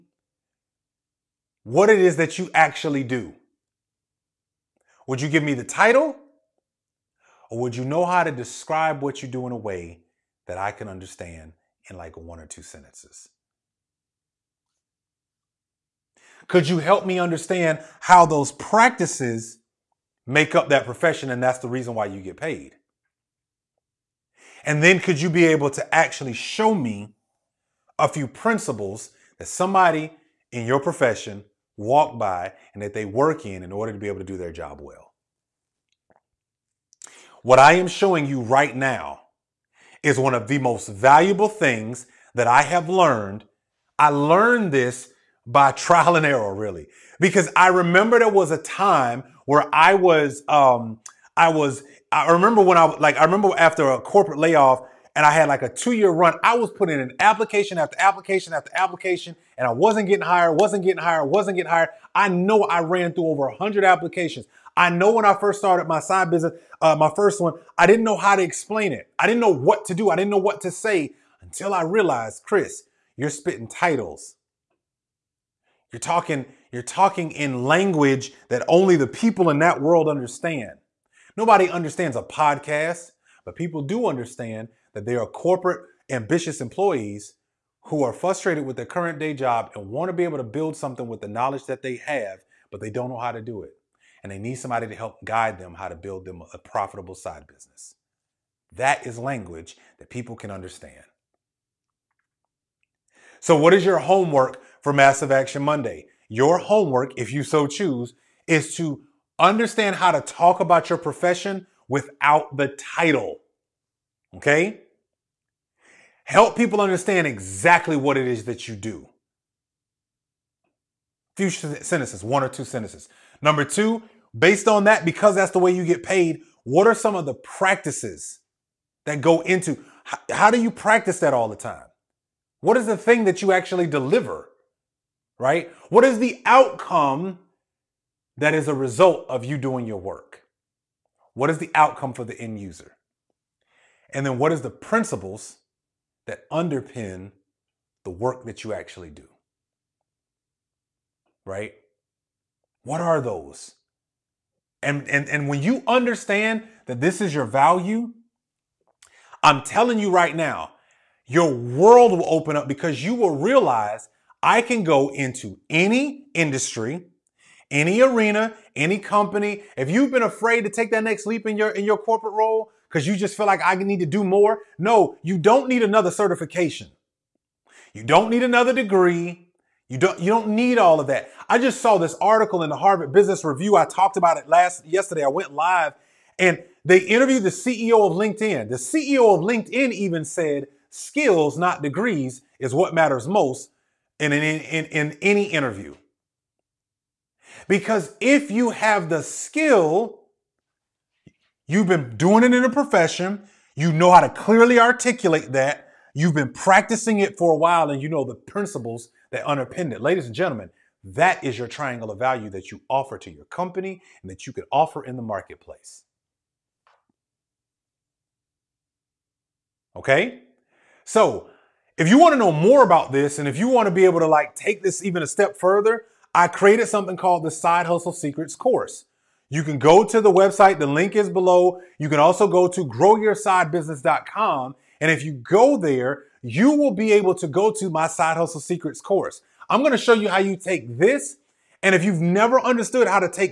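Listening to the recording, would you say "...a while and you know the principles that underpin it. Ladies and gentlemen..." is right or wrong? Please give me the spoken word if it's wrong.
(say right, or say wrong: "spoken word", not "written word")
right.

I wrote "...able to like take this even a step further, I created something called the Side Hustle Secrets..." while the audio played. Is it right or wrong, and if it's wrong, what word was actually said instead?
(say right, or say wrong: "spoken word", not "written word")
right.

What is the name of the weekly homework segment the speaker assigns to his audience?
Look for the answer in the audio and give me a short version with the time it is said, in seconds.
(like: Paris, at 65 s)
Massive Action Monday, at 104 s.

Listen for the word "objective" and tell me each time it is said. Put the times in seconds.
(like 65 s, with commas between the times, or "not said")
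not said.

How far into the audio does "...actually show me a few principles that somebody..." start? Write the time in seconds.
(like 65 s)
25 s.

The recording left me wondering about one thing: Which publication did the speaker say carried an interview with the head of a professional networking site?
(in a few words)
Harvard Business Review.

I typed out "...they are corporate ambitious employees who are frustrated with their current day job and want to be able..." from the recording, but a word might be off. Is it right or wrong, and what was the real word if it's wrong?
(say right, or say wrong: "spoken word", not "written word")
right.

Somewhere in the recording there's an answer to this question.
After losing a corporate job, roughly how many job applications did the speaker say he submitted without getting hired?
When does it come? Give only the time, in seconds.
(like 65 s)
63 s.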